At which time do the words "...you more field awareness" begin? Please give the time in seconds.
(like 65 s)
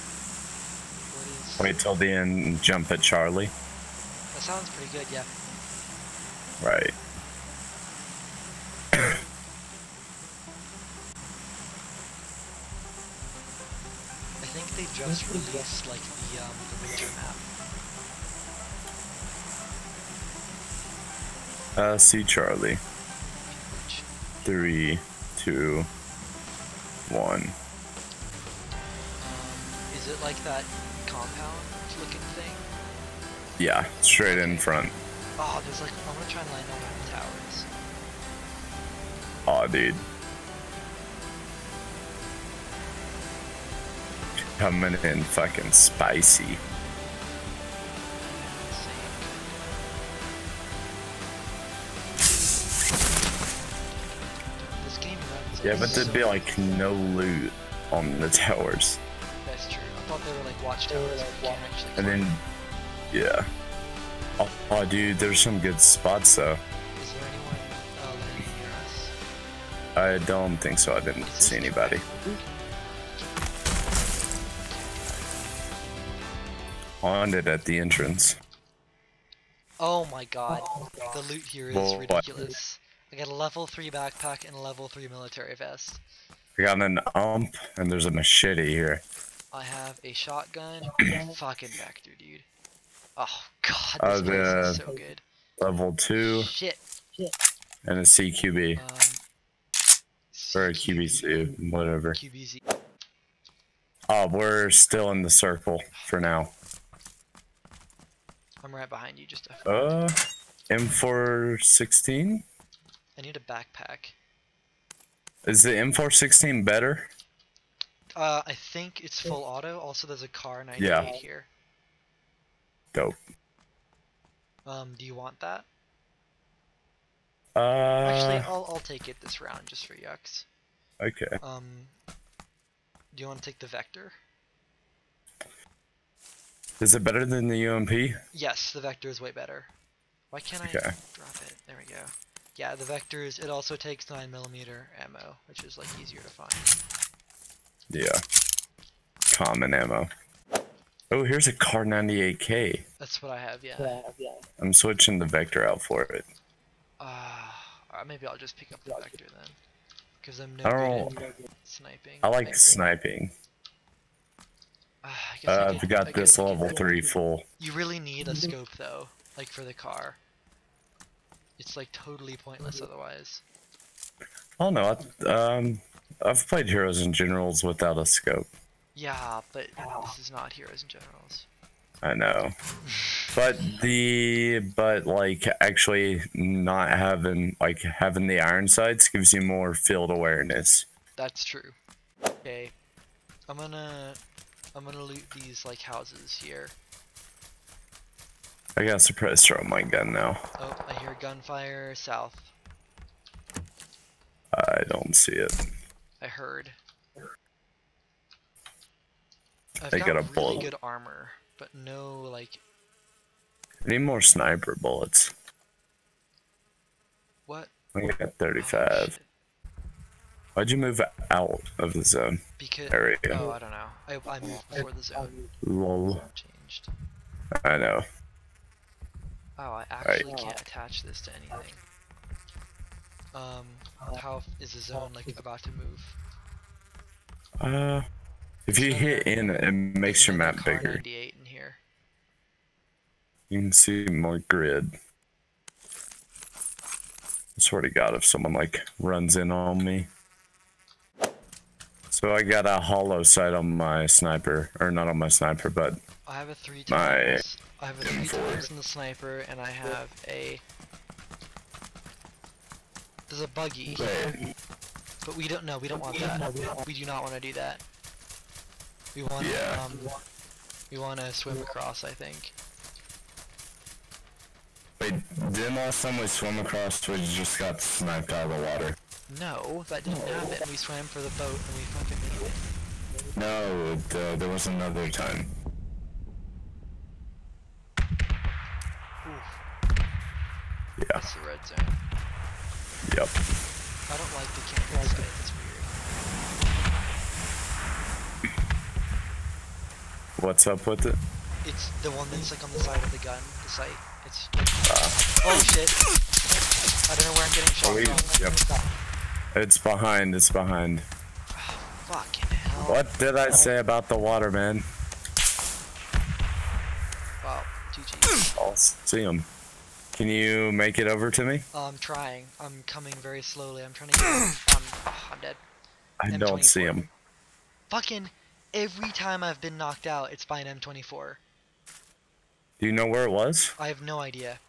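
189 s.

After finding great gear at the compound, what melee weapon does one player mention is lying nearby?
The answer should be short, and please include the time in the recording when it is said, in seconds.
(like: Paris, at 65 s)
machete, at 88 s.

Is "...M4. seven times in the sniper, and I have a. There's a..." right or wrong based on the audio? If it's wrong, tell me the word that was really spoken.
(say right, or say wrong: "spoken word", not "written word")
wrong: "three", not "seven".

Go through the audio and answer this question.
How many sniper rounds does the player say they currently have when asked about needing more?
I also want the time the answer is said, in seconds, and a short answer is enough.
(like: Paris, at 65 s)
35, at 218 s.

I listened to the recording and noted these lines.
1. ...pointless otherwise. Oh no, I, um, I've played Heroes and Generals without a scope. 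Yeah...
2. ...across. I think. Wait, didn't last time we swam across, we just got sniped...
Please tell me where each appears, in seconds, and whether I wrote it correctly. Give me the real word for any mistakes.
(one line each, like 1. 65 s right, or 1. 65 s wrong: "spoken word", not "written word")
1. 172 s right
2. 271 s right.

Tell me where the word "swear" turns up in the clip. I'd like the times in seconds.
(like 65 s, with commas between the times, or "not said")
247 s.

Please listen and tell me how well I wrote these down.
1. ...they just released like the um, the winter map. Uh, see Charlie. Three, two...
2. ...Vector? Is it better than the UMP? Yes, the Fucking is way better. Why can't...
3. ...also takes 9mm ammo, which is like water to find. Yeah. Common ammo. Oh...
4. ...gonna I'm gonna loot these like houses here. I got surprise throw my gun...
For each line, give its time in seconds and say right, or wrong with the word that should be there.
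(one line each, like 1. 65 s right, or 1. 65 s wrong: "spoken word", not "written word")
1. 14 s right
2. 133 s wrong: "Vector", not "Fucking"
3. 143 s wrong: "easier", not "water"
4. 193 s right.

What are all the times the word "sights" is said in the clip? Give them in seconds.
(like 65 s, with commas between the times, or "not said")
188 s, 253 s.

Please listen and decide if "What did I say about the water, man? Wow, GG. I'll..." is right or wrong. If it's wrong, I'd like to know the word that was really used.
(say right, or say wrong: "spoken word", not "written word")
right.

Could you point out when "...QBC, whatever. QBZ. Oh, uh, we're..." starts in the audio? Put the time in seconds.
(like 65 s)
100 s.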